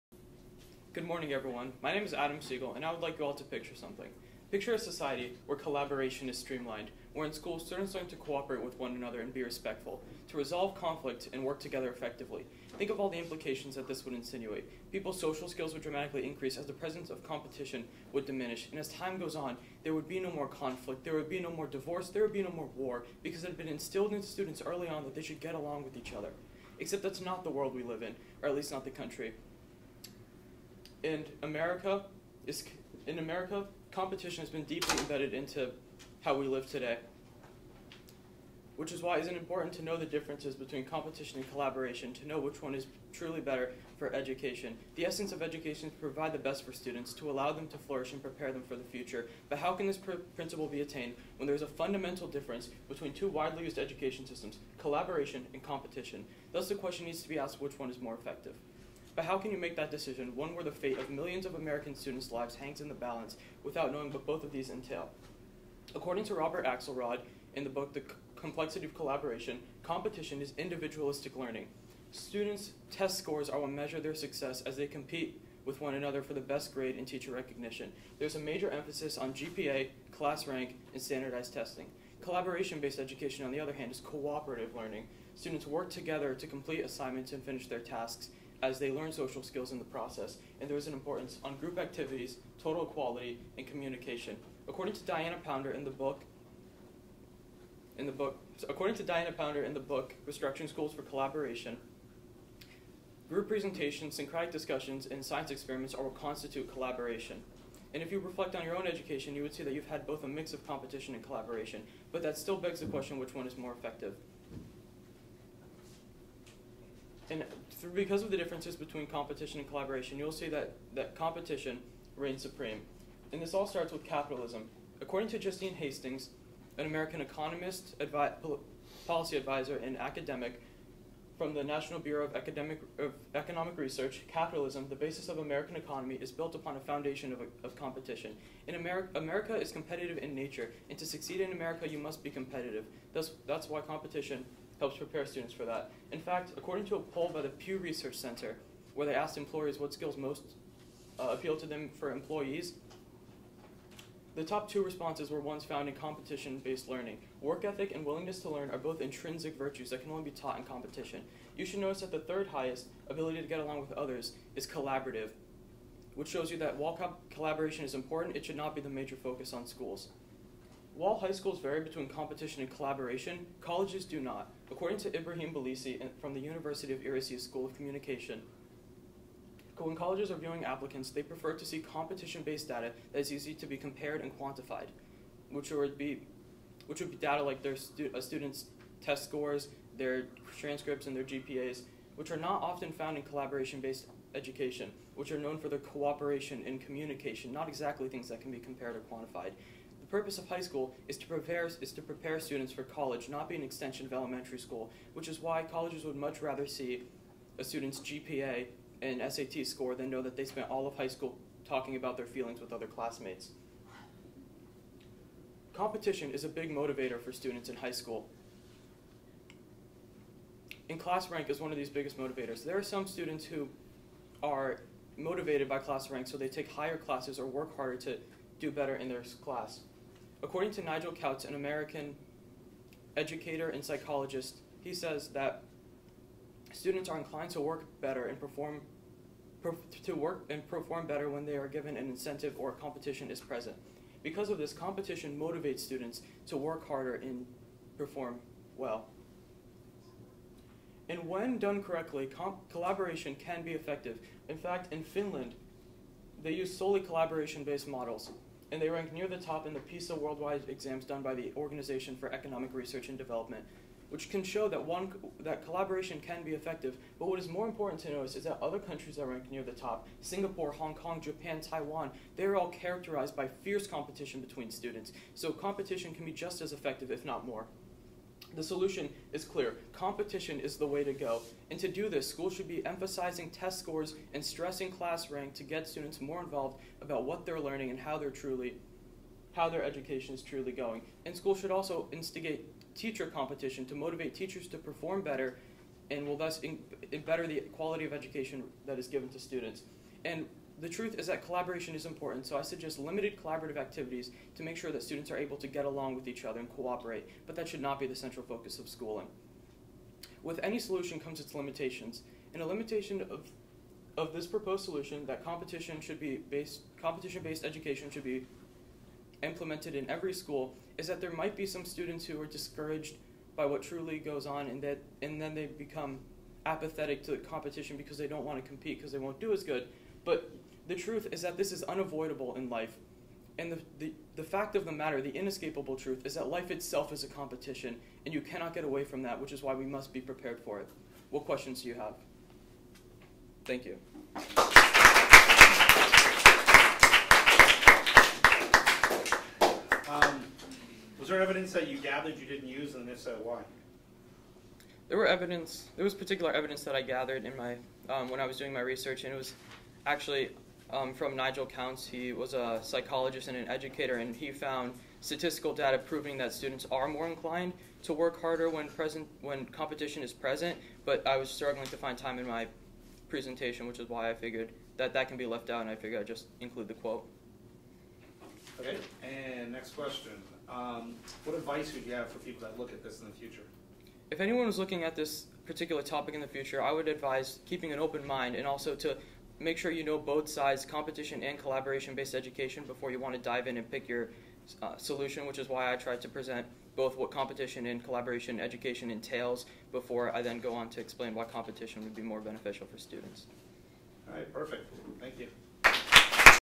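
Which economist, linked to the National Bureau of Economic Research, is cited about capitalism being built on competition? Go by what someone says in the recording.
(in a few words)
Justine Hastings.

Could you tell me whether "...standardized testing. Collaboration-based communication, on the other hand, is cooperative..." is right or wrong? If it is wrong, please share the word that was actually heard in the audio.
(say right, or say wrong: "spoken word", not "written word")
wrong: "education", not "communication".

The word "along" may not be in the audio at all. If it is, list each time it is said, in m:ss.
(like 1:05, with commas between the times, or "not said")
0:25, 2:43, 5:05.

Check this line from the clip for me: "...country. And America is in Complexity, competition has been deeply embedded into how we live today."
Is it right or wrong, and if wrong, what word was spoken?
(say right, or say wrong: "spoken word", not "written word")
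wrong: "America", not "Complexity".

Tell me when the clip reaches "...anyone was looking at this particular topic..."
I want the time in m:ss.
6:24.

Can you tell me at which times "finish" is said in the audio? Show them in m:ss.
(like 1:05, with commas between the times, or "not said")
1:27.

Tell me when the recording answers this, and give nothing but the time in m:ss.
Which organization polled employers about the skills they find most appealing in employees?
2:27.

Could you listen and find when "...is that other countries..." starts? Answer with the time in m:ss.
4:28.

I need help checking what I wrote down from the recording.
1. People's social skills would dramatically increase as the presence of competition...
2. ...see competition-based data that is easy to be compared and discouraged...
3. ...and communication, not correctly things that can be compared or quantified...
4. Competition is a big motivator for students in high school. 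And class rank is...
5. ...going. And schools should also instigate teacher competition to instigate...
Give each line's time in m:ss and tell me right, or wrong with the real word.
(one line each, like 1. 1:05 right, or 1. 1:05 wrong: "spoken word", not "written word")
1. 0:14 right
2. 3:01 wrong: "quantified", not "discouraged"
3. 3:16 wrong: "exactly", not "correctly"
4. 3:35 right
5. 4:50 wrong: "motivate", not "instigate".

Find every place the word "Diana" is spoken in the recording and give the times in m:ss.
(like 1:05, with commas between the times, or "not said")
1:35, 1:39.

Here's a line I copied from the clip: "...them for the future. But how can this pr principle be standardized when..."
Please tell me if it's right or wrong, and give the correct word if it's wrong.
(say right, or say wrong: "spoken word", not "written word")
wrong: "attained", not "standardized".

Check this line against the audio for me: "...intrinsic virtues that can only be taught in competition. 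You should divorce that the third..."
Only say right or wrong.
wrong.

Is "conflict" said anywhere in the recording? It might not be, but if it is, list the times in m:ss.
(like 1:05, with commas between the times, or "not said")
0:10, 0:20.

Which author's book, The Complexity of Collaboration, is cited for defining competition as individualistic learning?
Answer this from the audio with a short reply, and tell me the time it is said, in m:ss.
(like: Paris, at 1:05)
Robert Axelrod, at 1:06.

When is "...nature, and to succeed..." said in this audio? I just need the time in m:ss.
2:20.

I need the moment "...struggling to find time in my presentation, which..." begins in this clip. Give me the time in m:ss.
6:11.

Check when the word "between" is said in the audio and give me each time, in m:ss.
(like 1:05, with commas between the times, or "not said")
0:40, 0:52, 1:58, 2:51, 4:34.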